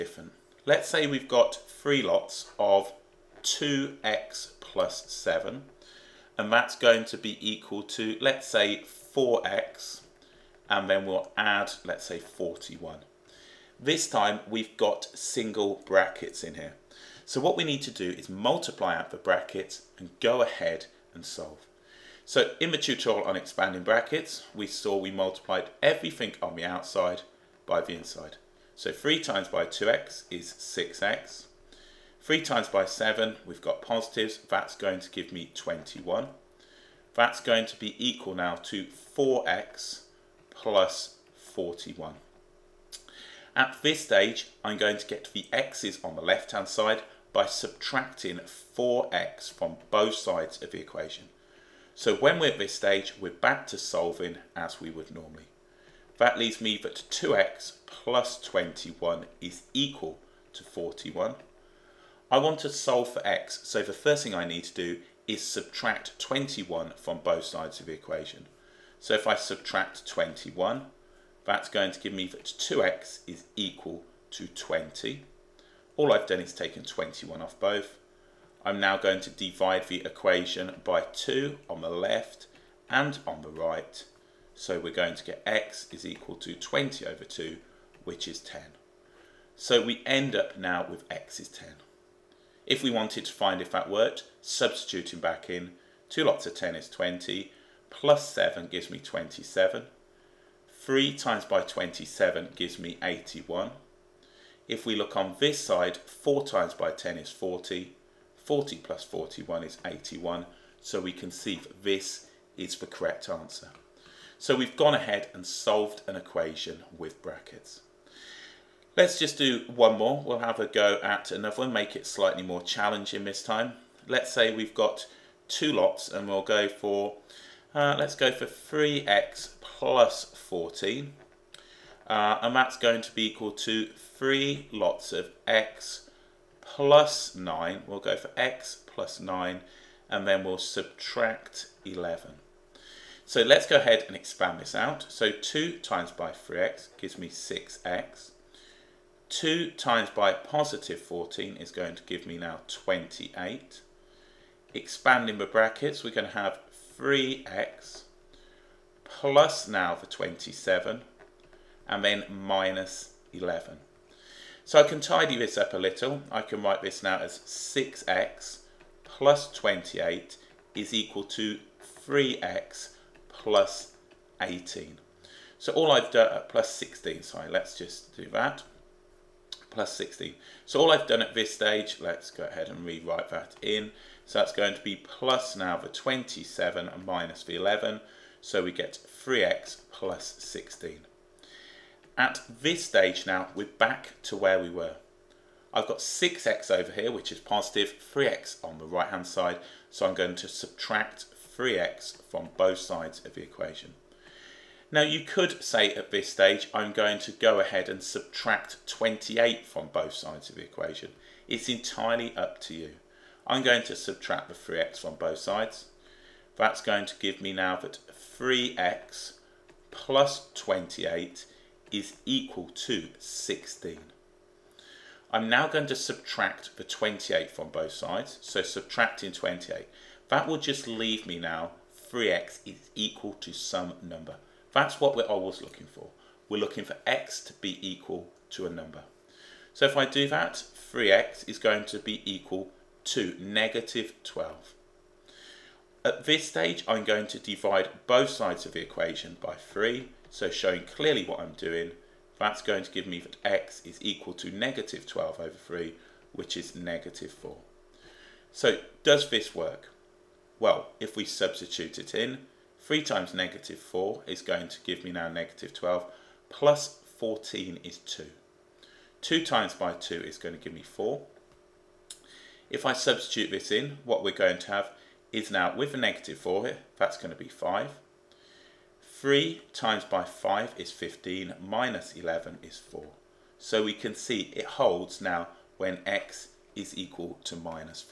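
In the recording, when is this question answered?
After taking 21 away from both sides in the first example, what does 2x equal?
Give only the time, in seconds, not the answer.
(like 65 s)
72 s.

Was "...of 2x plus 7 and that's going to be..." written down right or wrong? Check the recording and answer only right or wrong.
right.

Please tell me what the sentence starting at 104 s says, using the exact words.
If we look on this side, 4 times by 10 is 40.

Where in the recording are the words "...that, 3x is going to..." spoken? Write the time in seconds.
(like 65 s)
240 s.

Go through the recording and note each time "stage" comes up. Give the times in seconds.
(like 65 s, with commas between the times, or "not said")
43 s, 52 s, 181 s, 192 s, 206 s, 246 s.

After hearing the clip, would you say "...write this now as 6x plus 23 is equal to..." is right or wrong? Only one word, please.
wrong.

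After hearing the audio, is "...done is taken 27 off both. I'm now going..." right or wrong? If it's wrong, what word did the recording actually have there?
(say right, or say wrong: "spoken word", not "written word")
wrong: "21", not "27".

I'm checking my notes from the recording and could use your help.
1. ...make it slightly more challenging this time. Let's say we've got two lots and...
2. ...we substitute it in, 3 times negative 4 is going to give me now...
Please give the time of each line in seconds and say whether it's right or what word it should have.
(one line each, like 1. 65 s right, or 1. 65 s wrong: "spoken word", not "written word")
1. 121 s right
2. 261 s right.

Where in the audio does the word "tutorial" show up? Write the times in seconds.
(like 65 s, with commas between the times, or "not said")
22 s.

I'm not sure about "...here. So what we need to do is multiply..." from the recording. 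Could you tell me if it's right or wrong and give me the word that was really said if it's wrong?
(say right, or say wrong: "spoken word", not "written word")
right.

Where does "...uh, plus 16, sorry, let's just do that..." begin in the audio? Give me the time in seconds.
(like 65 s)
176 s.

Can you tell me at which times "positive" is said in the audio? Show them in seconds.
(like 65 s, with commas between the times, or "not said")
33 s, 150 s, 197 s.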